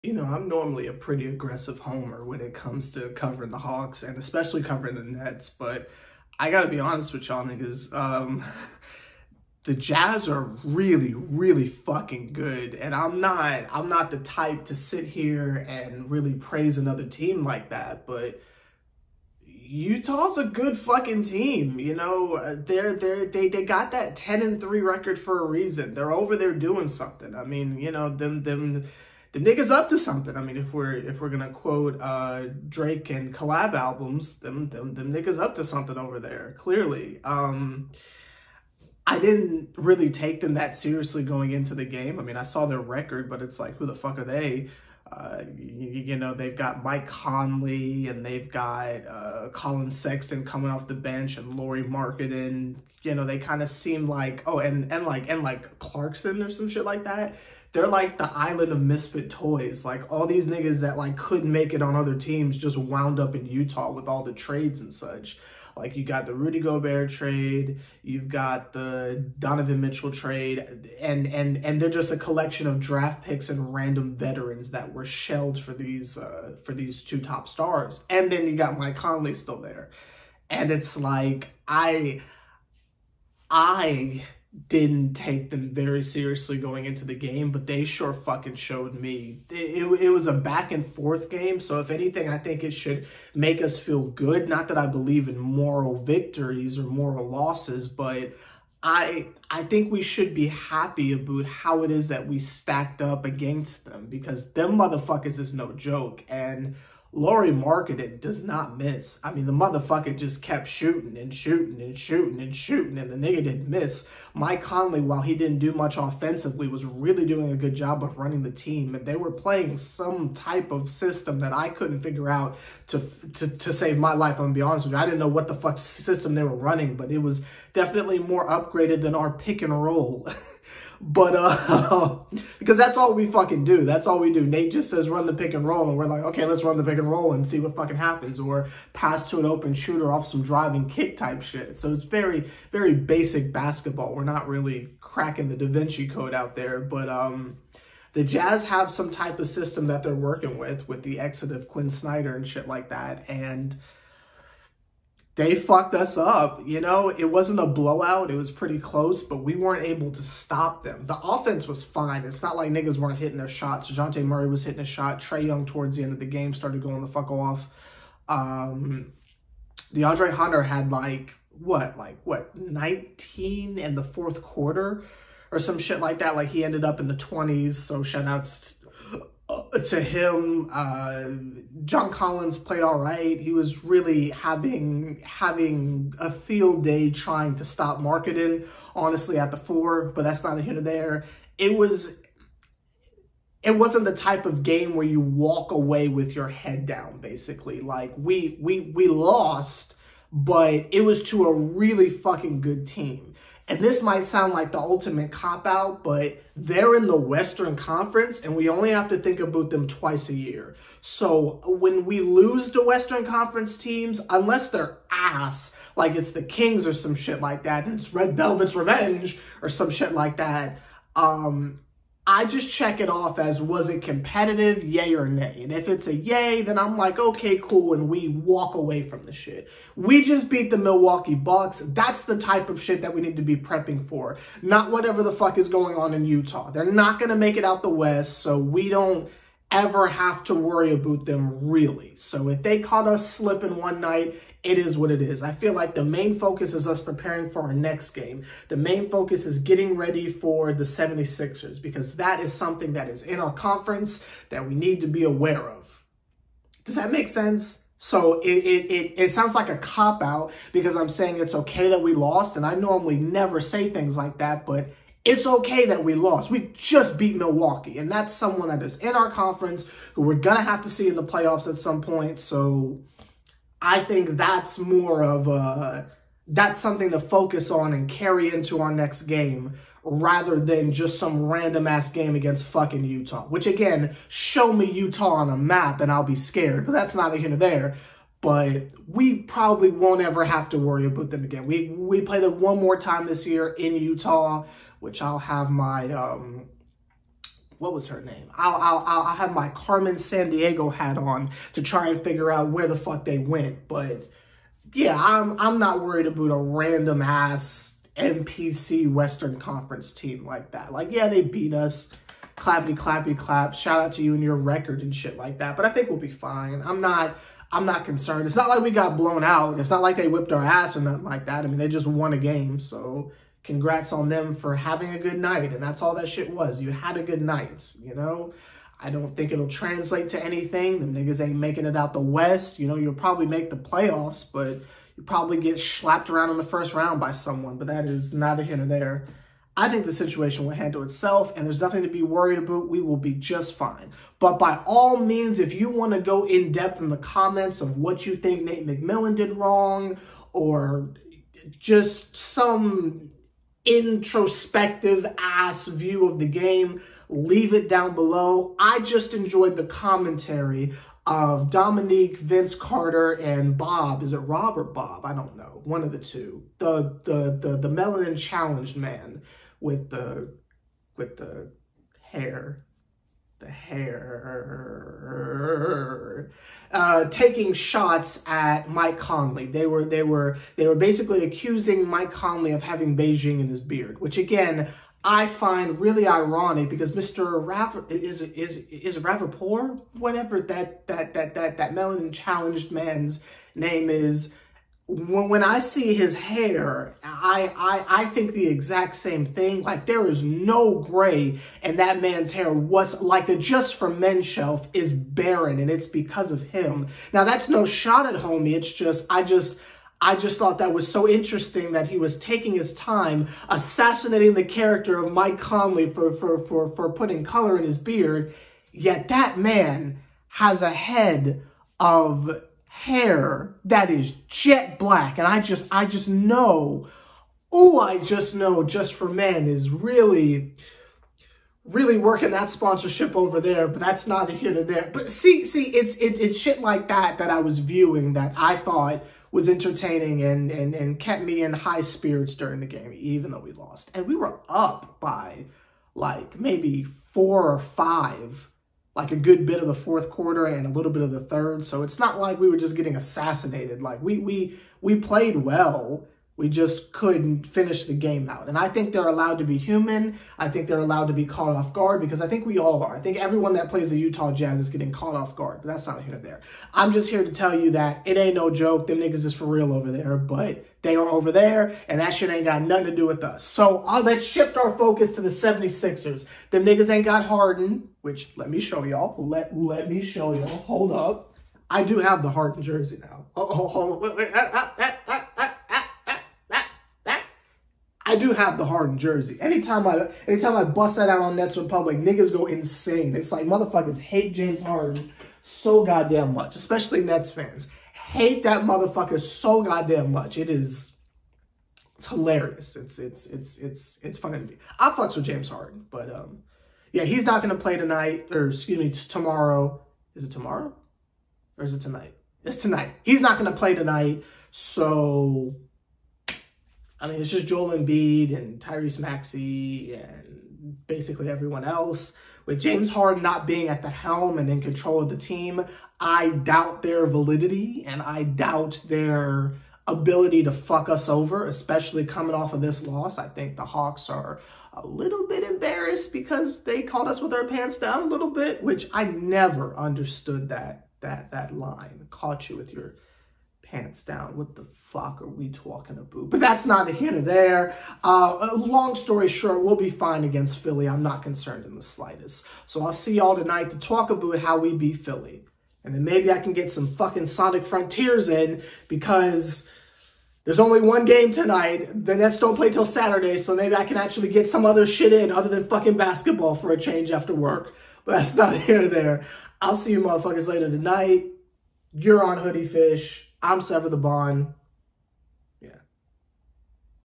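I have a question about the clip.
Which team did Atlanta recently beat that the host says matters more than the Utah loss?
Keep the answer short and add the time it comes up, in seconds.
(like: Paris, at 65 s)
Milwaukee Bucks, at 230 s.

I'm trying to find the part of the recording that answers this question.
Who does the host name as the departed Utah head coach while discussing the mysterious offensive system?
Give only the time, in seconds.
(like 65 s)
151 s.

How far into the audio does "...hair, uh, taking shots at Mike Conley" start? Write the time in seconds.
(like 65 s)
373 s.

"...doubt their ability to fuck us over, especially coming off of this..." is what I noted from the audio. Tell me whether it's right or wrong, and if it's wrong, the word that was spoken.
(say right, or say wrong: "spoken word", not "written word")
right.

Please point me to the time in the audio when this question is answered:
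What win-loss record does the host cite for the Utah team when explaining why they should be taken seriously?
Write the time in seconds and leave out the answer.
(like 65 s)
24 s.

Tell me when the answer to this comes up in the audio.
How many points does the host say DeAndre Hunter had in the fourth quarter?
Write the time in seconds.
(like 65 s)
172 s.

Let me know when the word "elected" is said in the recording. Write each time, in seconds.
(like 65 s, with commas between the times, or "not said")
not said.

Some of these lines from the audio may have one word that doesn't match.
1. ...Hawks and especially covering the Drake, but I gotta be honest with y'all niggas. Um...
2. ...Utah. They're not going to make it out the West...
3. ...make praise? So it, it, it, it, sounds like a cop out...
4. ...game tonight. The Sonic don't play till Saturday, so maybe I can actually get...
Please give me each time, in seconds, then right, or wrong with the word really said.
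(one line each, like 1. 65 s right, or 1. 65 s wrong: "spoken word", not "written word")
1. 3 s wrong: "Nets", not "Drake"
2. 236 s right
3. 257 s wrong: "sense", not "praise"
4. 561 s wrong: "Nets", not "Sonic".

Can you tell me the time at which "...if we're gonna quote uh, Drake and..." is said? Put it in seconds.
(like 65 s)
30 s.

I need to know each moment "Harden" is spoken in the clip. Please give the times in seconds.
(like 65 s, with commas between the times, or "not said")
477 s, 482 s, 488 s, 494 s, 505 s, 523 s.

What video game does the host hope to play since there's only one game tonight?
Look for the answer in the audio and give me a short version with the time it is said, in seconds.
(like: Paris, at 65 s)
Sonic Frontiers, at 557 s.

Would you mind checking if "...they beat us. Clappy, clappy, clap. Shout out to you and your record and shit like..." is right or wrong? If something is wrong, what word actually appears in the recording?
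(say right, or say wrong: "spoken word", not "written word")
right.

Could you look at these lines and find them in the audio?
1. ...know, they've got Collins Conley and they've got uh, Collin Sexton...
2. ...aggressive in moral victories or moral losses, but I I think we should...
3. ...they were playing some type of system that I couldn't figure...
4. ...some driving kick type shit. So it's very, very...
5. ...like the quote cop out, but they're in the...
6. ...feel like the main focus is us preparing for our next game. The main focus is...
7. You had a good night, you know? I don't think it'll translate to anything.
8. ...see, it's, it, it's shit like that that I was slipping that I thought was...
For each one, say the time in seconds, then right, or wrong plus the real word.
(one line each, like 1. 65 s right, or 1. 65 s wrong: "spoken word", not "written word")
1. 46 s wrong: "Mike", not "Collins"
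2. 94 s wrong: "believe", not "aggressive"
3. 119 s right
4. 140 s right
5. 204 s wrong: "ultimate", not "quote"
6. 245 s right
7. 326 s right
8. 435 s wrong: "viewing", not "slipping".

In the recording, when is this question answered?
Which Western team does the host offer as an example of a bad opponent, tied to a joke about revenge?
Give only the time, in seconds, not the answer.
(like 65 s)
216 s.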